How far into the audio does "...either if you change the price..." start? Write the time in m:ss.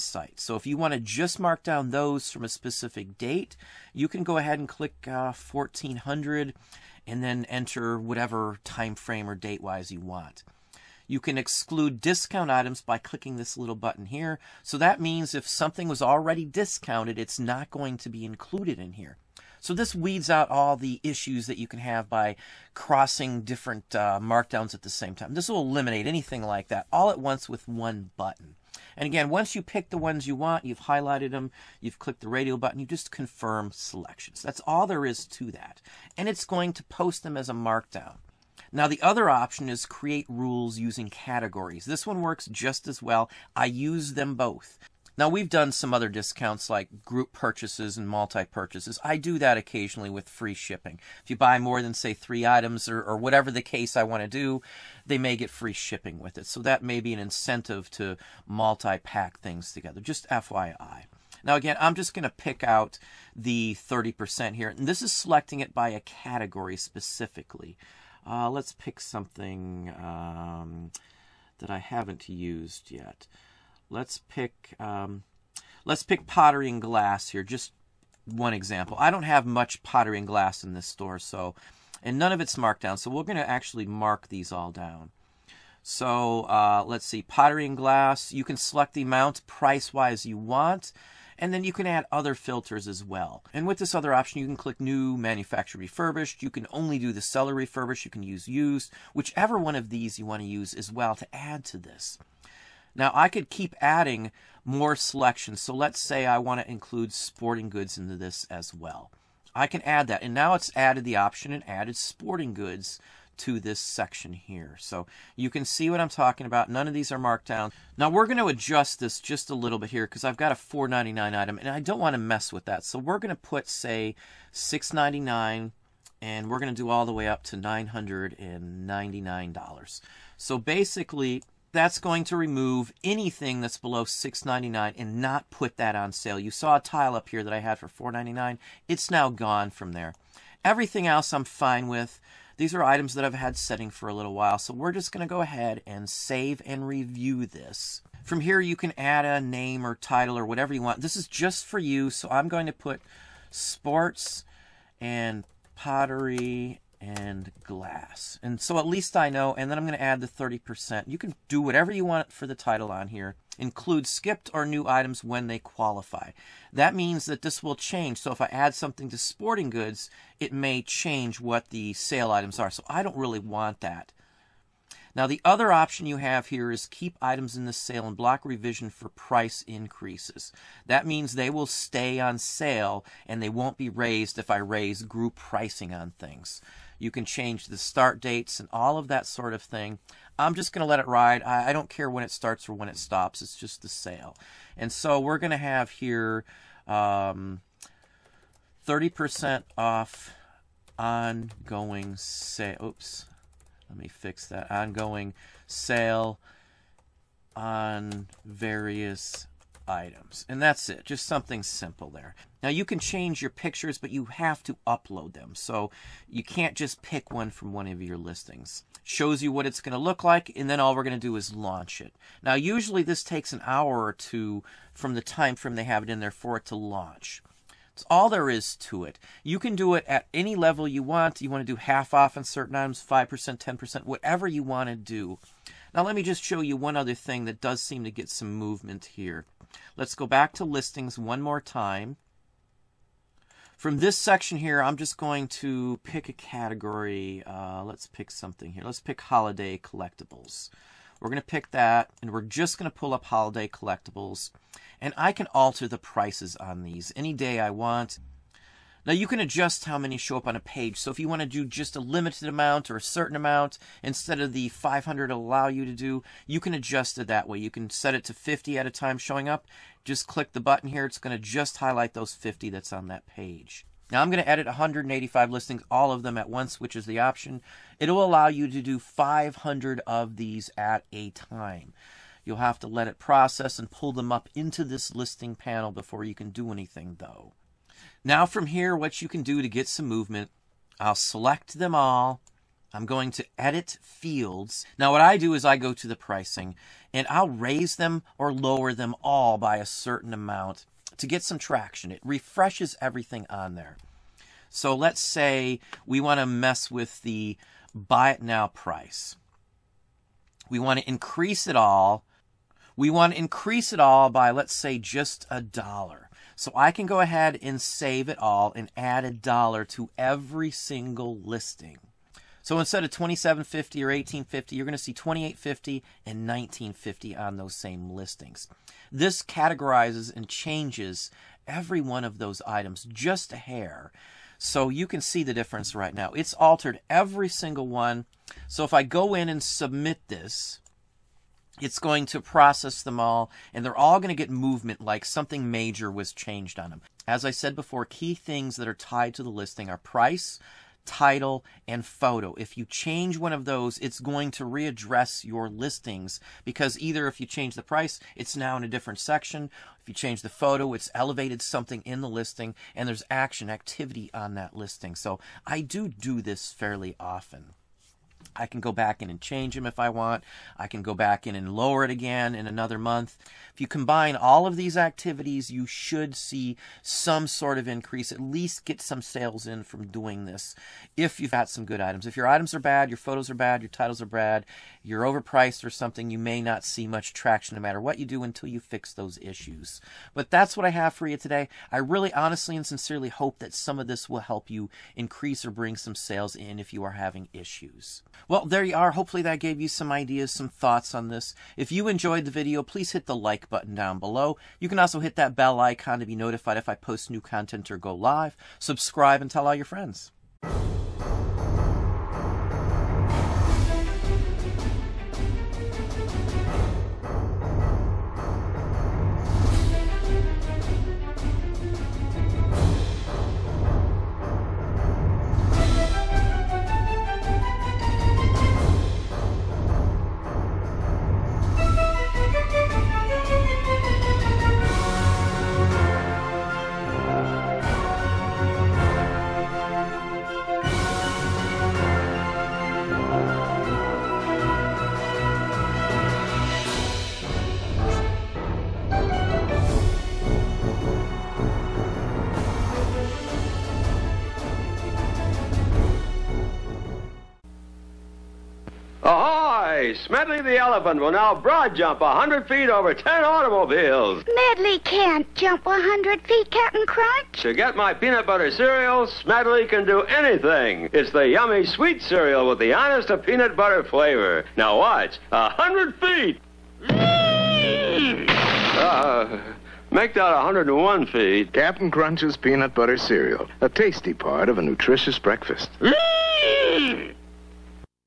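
5:56.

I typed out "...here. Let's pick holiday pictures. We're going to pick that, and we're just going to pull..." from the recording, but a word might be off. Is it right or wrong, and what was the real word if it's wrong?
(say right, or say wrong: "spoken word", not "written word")
wrong: "collectibles", not "pictures".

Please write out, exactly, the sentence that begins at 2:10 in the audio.
So basically that's going to remove anything that's below 6.99 and not put that on sale.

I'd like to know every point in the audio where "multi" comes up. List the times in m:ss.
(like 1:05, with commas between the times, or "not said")
0:48, 0:58.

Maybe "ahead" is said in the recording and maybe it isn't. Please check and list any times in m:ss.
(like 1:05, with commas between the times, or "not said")
0:04, 2:25, 5:17.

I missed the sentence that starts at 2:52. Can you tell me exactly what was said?
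So I don't really want that.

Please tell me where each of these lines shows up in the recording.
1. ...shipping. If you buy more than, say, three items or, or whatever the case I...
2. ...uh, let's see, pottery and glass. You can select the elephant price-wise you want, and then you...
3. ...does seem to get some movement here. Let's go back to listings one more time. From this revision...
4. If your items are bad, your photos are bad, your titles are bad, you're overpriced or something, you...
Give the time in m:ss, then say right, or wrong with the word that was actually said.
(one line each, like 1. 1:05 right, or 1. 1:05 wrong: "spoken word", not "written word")
1. 0:50 right
2. 1:26 wrong: "amount", not "elephant"
3. 3:57 wrong: "section", not "revision"
4. 6:22 right.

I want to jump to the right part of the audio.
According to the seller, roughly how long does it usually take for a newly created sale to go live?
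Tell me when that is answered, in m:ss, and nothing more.
3:43.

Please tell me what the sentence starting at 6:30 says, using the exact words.
But that's what I have for you today.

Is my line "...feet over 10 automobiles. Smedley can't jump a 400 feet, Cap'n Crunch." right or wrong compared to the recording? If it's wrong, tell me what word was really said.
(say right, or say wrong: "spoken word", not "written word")
wrong: "100", not "400".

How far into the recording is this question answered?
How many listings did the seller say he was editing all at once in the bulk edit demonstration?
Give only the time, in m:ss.
4:34.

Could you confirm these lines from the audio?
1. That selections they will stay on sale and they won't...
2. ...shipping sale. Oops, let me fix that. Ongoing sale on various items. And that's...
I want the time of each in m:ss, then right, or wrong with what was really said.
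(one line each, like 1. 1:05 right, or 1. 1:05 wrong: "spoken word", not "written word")
1. 3:00 wrong: "means", not "selections"
2. 3:20 wrong: "ongoing", not "shipping".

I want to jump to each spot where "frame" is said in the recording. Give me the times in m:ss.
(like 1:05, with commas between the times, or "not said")
0:08, 3:45.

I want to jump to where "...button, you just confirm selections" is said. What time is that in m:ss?
0:32.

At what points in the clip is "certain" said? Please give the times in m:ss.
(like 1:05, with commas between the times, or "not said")
3:52, 4:23, 4:59.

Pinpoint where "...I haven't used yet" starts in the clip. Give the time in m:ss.
1:11.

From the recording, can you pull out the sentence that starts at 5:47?
As I said before, key things that are tied to the listing are price, title, and photo.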